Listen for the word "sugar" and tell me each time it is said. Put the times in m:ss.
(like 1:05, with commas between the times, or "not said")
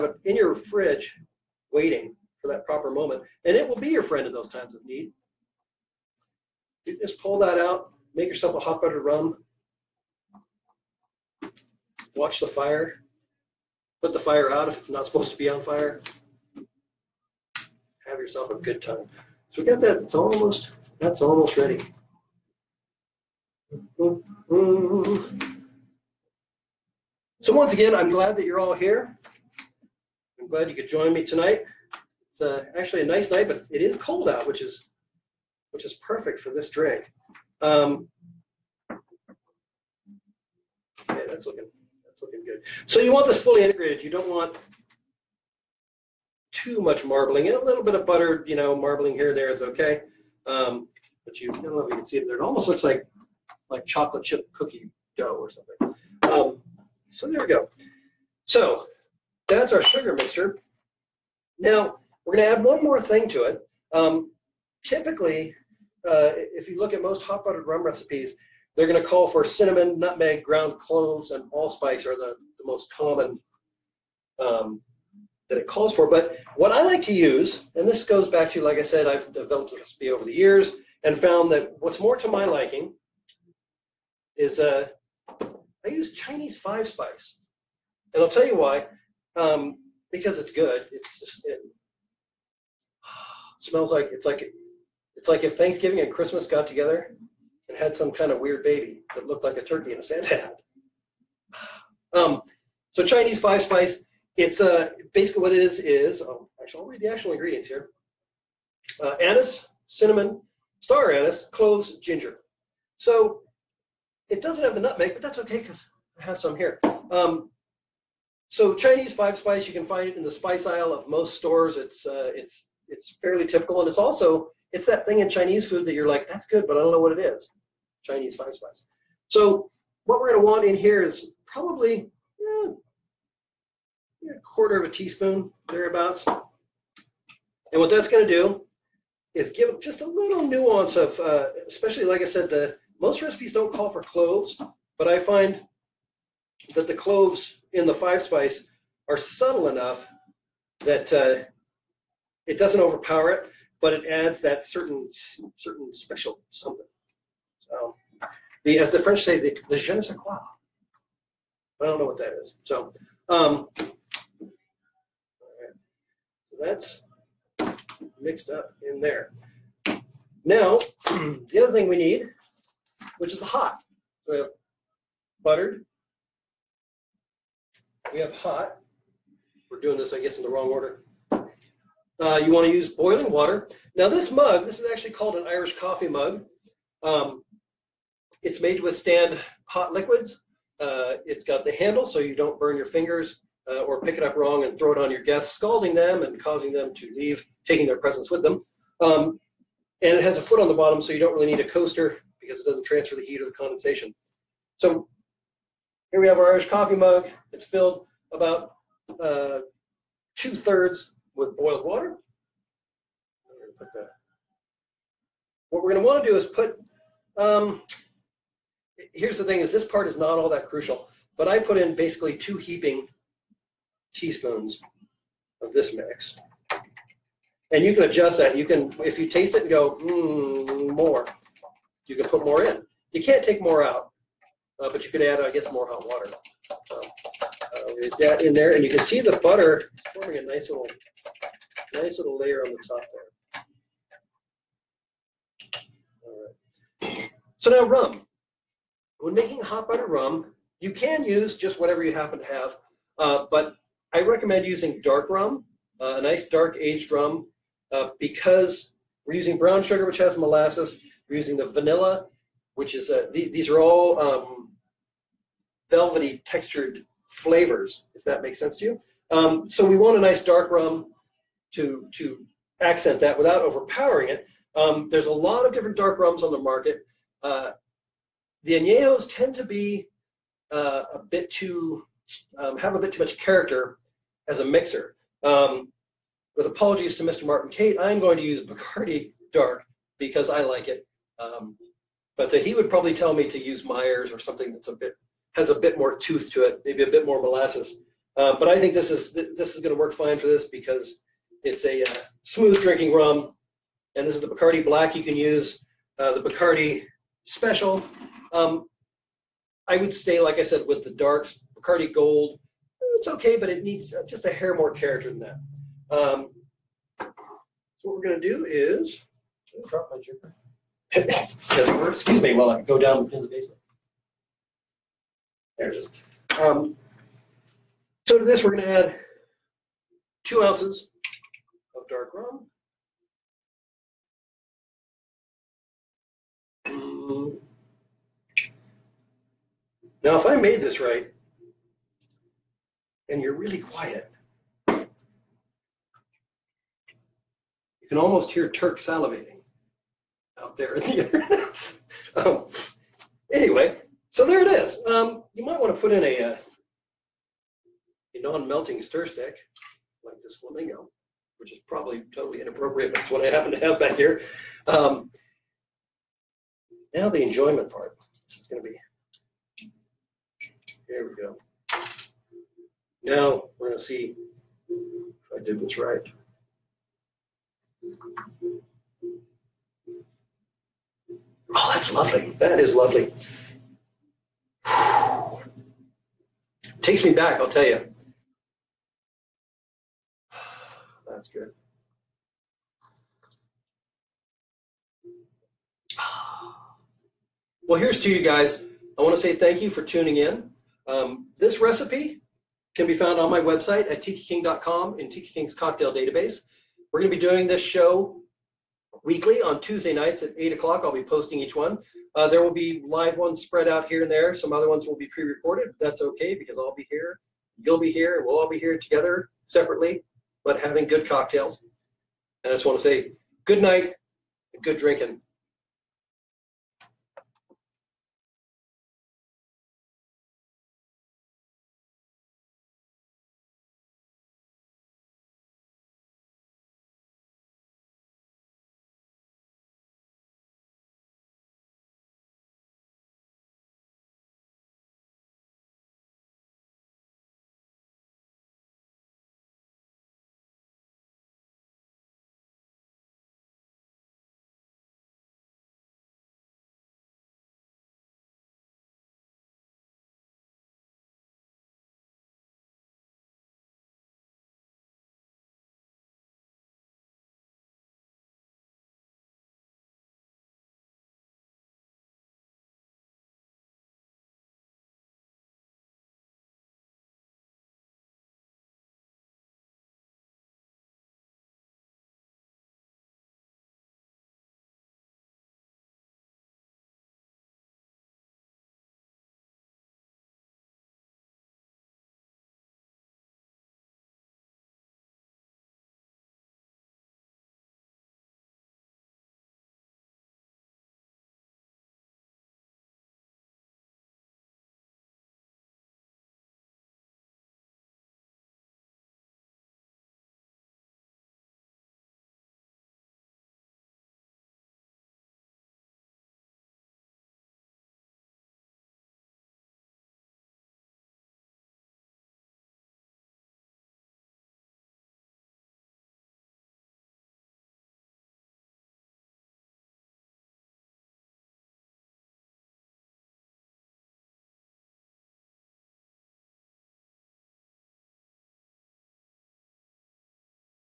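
0:59, 4:19.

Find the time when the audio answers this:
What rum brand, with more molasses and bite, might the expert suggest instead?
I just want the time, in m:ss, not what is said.
4:53.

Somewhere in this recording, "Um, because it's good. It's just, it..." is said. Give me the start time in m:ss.
1:29.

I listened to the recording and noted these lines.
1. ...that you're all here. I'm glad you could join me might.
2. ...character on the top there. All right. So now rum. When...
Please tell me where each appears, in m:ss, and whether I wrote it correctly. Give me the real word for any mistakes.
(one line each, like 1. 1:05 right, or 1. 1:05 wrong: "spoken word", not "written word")
1. 0:28 wrong: "tonight", not "might"
2. 4:02 wrong: "layer", not "character".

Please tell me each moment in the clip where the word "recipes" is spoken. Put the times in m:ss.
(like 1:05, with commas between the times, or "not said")
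1:07, 1:19, 2:23, 6:41.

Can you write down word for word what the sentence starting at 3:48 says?
You can, if you taste it and go, mm, more, you can put more in.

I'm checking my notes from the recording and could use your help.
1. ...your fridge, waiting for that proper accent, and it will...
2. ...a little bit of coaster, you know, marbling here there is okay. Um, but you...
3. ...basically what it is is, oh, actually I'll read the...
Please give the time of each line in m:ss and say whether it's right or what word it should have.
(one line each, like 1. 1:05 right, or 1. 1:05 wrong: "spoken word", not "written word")
1. 0:00 wrong: "moment", not "accent"
2. 0:47 wrong: "butter", not "coaster"
3. 1:45 right.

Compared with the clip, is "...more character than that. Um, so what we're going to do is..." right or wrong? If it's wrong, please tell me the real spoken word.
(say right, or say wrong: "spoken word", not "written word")
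right.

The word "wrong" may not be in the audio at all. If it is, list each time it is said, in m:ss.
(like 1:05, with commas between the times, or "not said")
3:00, 3:14.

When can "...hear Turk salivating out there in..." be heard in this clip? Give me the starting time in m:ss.
5:48.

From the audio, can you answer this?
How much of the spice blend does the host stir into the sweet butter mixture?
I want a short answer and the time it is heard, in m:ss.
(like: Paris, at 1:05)
1/4 teaspoon, at 2:14.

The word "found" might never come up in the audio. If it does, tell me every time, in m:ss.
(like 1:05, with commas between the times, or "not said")
1:21, 6:43.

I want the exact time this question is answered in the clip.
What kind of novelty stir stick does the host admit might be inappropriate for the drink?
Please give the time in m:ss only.
6:00.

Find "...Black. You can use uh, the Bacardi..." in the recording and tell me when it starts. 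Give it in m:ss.
5:04.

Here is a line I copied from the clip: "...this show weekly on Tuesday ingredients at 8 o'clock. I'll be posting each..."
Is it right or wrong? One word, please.
wrong.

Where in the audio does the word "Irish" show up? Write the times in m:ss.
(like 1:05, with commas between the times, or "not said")
3:05, 3:26.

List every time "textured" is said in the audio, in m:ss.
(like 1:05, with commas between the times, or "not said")
4:26.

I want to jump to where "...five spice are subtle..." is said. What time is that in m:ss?
2:27.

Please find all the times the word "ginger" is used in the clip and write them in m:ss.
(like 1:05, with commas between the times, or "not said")
1:51.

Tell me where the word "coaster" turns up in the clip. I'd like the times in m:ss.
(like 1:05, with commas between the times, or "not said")
3:21.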